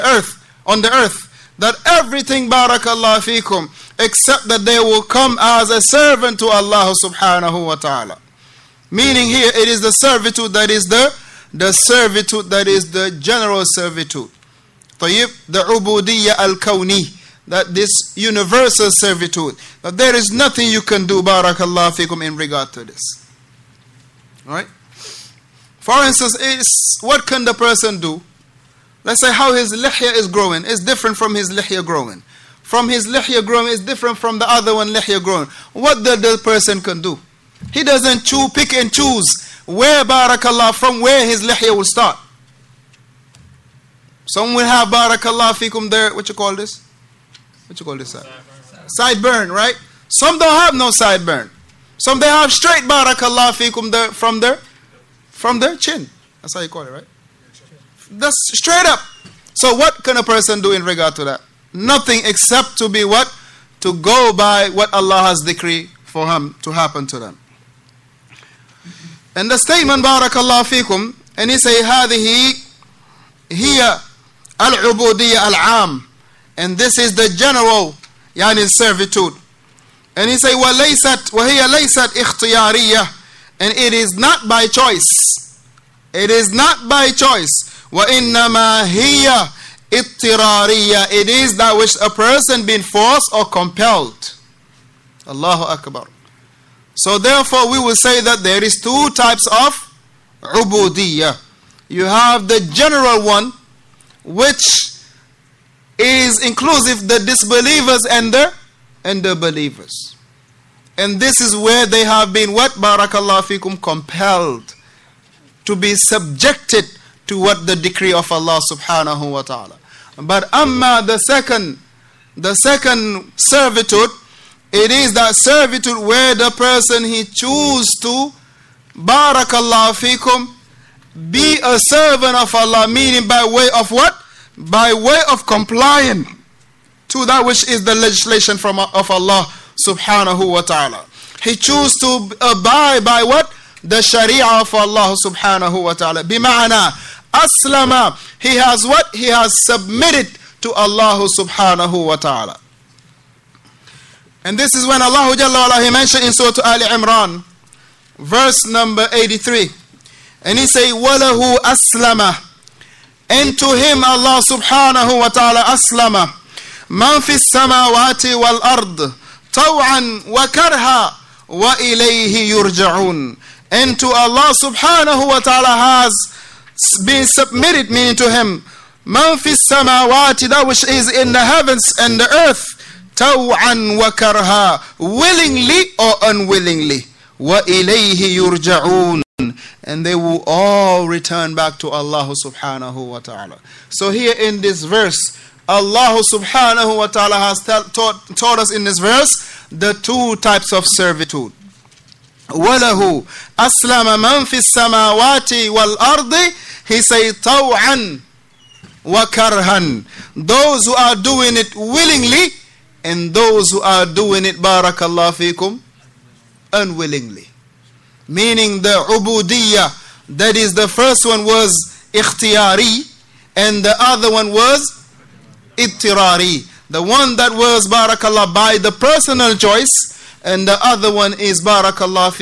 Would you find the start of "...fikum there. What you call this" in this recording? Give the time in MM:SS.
00:45.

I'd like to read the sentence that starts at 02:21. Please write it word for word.
He chose to abide by what?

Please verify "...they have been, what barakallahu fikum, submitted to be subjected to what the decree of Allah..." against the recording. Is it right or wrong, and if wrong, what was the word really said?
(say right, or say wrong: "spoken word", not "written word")
wrong: "compelled", not "submitted".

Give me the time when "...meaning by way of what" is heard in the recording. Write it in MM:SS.
02:12.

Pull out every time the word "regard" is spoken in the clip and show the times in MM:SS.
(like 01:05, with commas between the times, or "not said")
00:22, 01:00.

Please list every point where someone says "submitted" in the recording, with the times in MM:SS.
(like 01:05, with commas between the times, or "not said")
02:29, 02:57.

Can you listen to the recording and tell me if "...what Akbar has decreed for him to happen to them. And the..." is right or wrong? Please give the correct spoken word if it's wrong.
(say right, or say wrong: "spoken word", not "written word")
wrong: "Allah", not "Akbar".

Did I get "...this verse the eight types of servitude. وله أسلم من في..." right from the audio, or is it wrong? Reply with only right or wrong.
wrong.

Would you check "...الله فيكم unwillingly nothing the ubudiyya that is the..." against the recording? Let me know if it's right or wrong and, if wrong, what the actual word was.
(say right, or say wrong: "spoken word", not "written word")
wrong: "meaning", not "nothing".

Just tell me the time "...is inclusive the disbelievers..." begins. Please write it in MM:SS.
01:45.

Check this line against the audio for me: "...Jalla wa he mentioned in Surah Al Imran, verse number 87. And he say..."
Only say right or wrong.
wrong.